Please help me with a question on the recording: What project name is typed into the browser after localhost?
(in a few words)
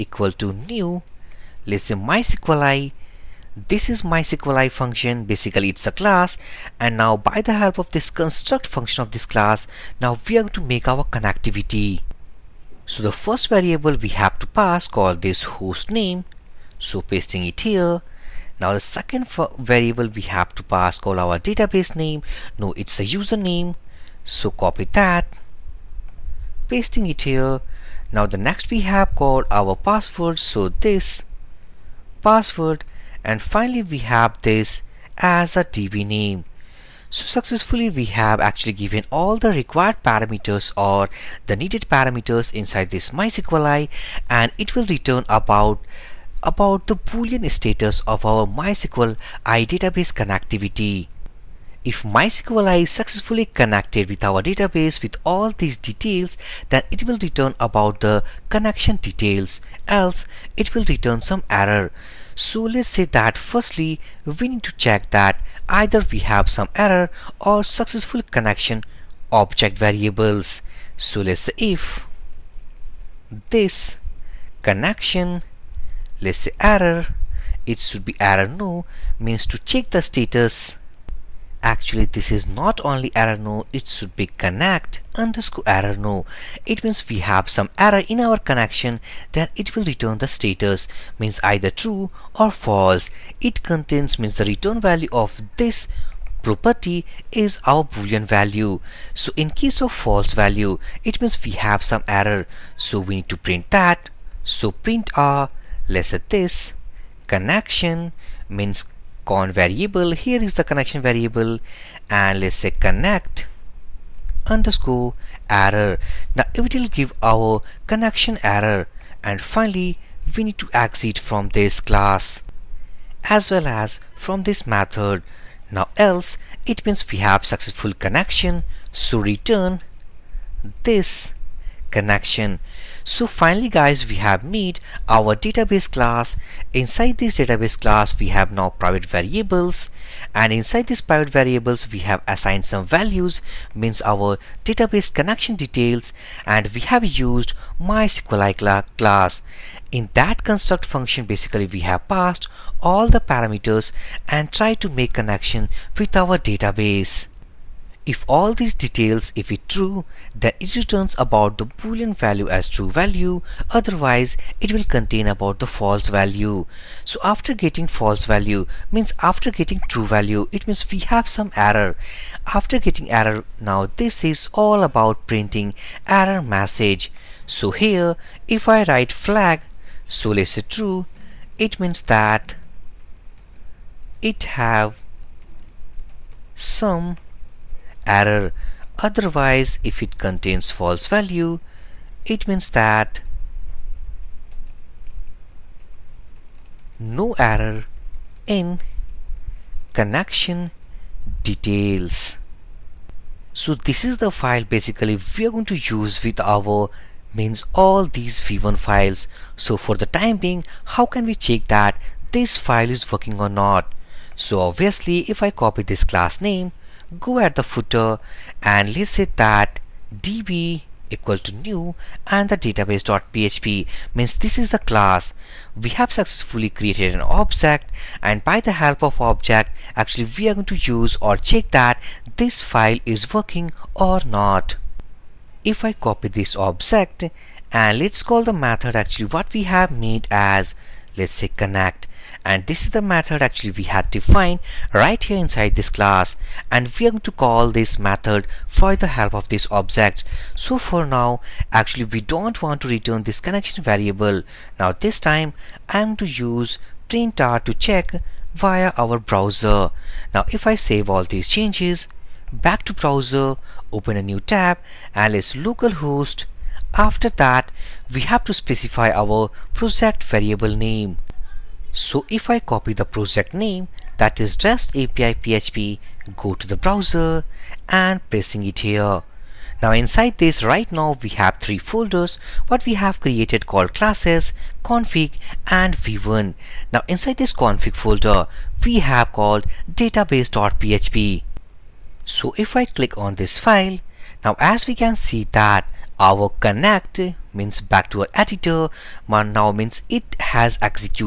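REST API PHP.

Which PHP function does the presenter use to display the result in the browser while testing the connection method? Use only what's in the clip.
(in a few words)
print_r.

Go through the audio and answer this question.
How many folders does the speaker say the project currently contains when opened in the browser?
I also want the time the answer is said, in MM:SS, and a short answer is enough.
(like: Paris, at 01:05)
3, at 04:41.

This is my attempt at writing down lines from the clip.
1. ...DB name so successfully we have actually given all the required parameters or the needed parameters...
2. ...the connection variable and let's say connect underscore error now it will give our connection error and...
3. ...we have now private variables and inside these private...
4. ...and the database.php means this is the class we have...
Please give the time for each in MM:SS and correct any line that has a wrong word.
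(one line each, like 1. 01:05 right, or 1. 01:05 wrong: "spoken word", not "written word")
1. 00:35 right
2. 01:50 right
3. 02:18 right
4. 03:42 right.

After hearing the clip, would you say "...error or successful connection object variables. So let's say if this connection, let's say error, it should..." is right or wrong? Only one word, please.
right.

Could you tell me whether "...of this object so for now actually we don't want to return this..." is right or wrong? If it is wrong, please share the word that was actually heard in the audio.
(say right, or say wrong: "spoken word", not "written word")
right.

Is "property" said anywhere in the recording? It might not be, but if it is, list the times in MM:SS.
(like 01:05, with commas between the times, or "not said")
01:36.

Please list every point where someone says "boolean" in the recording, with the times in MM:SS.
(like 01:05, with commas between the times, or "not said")
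00:46, 01:37, 02:41.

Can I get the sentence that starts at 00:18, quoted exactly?
Now the second variable we have to pass call our database name.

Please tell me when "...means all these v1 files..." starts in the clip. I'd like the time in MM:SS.
03:27.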